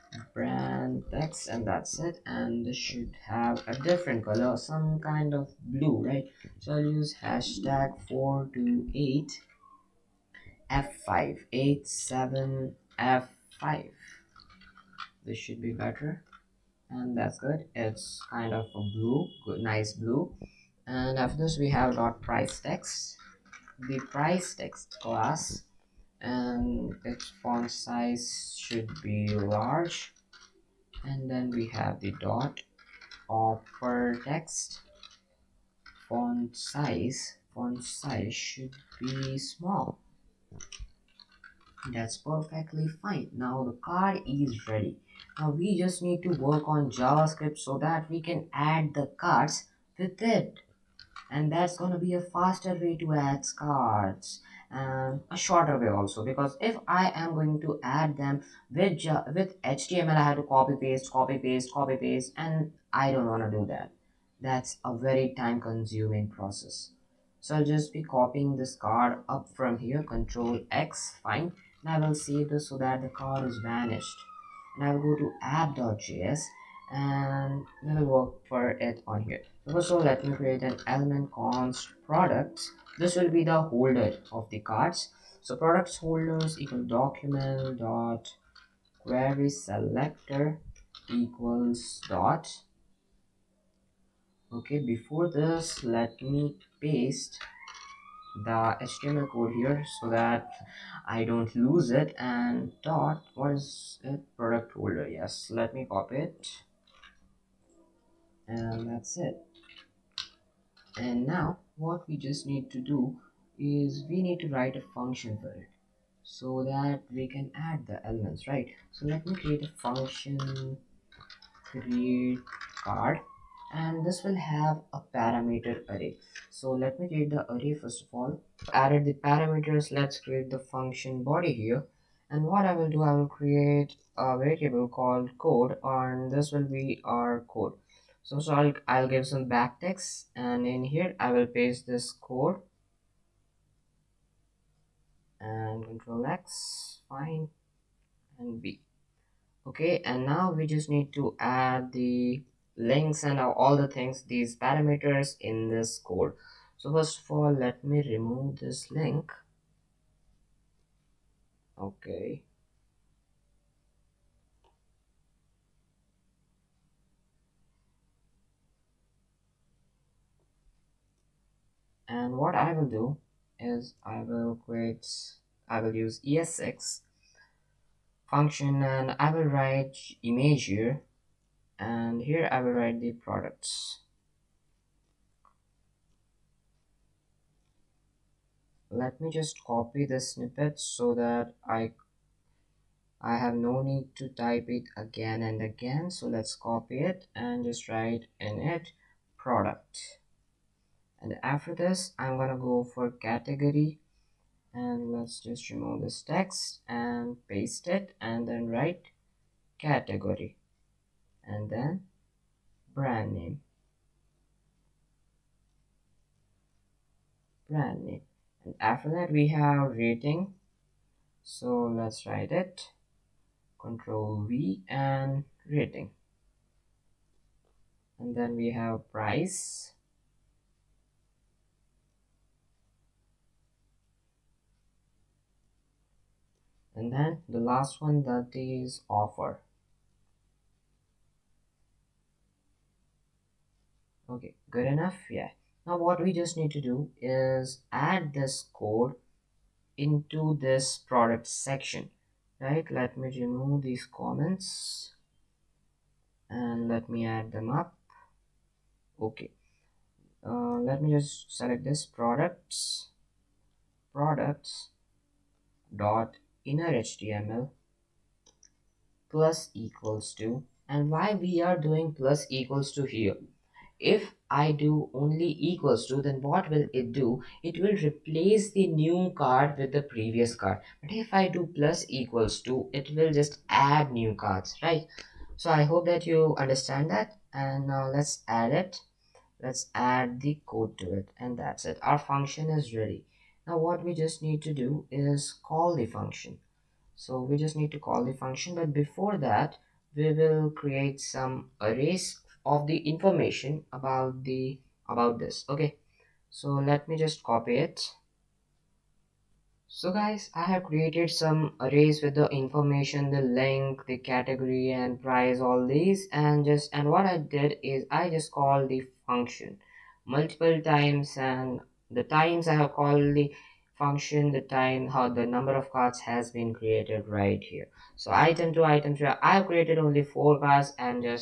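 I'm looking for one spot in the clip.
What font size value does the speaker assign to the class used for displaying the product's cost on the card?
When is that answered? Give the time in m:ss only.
0:29.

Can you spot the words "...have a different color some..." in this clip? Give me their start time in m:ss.
0:03.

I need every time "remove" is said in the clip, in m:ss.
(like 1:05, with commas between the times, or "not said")
2:38, 3:25, 4:13.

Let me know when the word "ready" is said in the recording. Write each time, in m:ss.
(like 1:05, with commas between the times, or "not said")
0:44, 4:52.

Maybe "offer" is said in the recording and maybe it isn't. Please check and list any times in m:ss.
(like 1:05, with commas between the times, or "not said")
0:33, 3:59.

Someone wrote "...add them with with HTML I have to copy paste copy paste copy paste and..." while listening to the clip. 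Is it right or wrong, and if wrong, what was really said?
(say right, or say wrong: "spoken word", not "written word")
right.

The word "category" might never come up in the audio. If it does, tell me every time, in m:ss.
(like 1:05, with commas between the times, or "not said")
3:23, 3:29, 5:14.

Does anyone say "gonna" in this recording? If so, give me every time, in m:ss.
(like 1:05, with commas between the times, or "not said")
0:51, 3:22.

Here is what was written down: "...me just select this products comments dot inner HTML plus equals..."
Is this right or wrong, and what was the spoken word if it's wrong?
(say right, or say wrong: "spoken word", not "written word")
wrong: "products", not "comments".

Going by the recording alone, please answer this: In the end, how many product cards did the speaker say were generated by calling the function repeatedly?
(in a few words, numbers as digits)
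4.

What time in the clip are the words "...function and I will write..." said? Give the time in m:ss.
2:58.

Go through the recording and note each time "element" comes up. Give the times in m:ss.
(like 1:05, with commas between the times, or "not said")
1:20, 1:58.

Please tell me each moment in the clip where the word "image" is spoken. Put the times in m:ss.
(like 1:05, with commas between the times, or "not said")
3:00.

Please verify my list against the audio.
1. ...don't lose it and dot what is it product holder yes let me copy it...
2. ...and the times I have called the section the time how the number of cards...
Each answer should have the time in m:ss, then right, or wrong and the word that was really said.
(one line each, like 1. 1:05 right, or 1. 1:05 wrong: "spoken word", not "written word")
1. 1:41 right
2. 5:21 wrong: "function", not "section".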